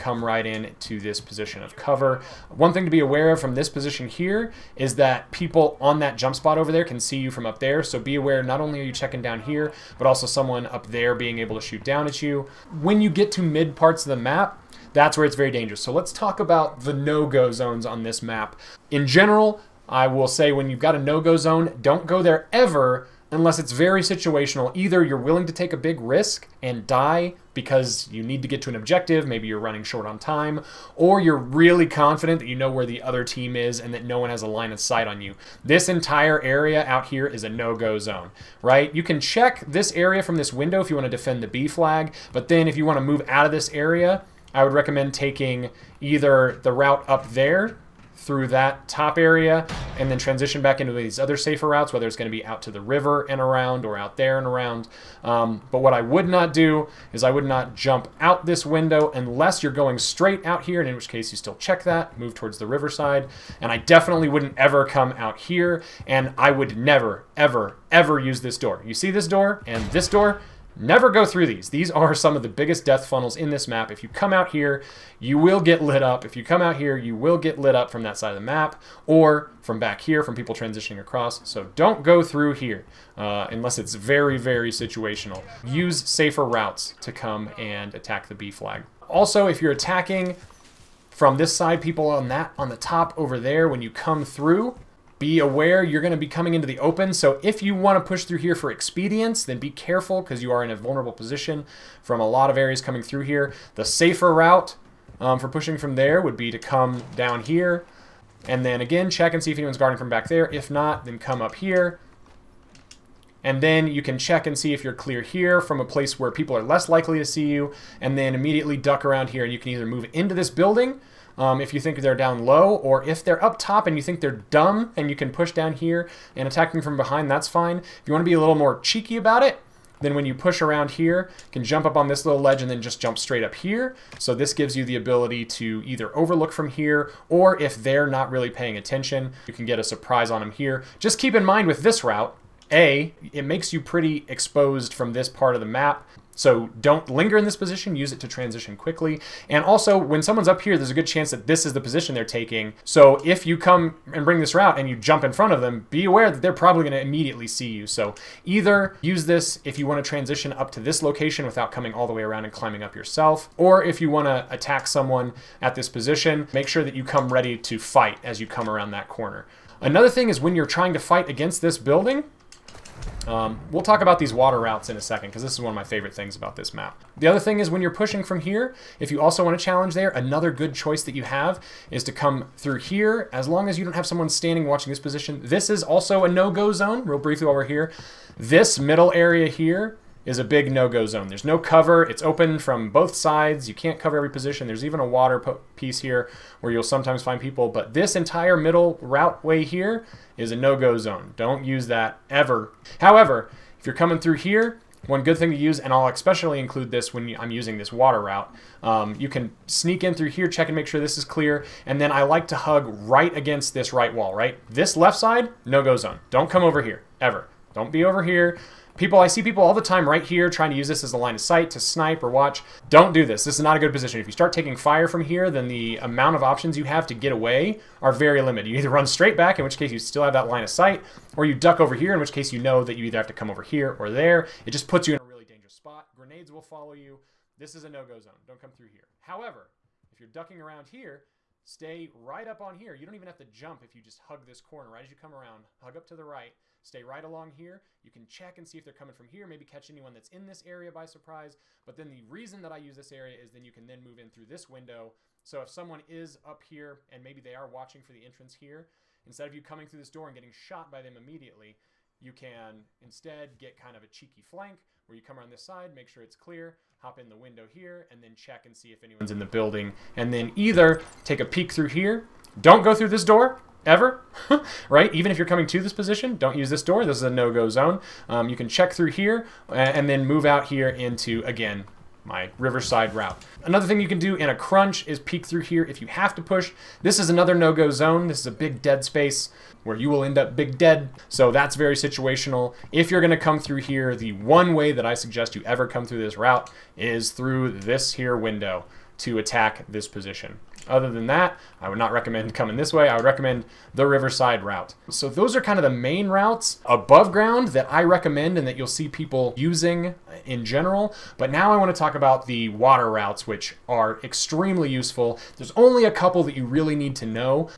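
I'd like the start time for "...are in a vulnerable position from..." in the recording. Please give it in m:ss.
1:40.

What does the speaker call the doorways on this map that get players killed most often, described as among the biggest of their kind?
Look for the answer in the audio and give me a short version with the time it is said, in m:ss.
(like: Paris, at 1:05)
death funnels, at 1:12.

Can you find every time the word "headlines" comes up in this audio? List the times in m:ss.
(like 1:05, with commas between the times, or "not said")
not said.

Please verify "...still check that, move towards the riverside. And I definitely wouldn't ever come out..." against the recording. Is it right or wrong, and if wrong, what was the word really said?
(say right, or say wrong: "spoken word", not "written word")
right.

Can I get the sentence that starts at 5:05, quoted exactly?
So those are kind of the main routes above ground that I recommend and that you'll see people using in general.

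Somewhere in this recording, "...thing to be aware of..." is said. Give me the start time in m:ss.
0:02.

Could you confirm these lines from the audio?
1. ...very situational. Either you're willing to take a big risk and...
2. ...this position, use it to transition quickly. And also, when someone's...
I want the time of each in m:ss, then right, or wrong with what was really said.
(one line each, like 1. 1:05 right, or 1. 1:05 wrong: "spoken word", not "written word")
1. 0:23 right
2. 2:27 right.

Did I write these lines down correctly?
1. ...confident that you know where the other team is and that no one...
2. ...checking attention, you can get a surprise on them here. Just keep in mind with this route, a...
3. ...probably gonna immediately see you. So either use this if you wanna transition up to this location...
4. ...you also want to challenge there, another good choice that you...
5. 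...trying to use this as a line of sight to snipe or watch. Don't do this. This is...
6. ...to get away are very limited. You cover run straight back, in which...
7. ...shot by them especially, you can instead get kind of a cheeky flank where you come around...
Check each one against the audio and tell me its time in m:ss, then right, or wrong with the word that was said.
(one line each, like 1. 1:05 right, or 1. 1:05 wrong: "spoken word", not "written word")
1. 0:31 right
2. 2:18 wrong: "paying", not "checking"
3. 2:36 right
4. 2:59 right
5. 3:40 right
6. 3:47 wrong: "either", not "cover"
7. 4:20 wrong: "immediately", not "especially".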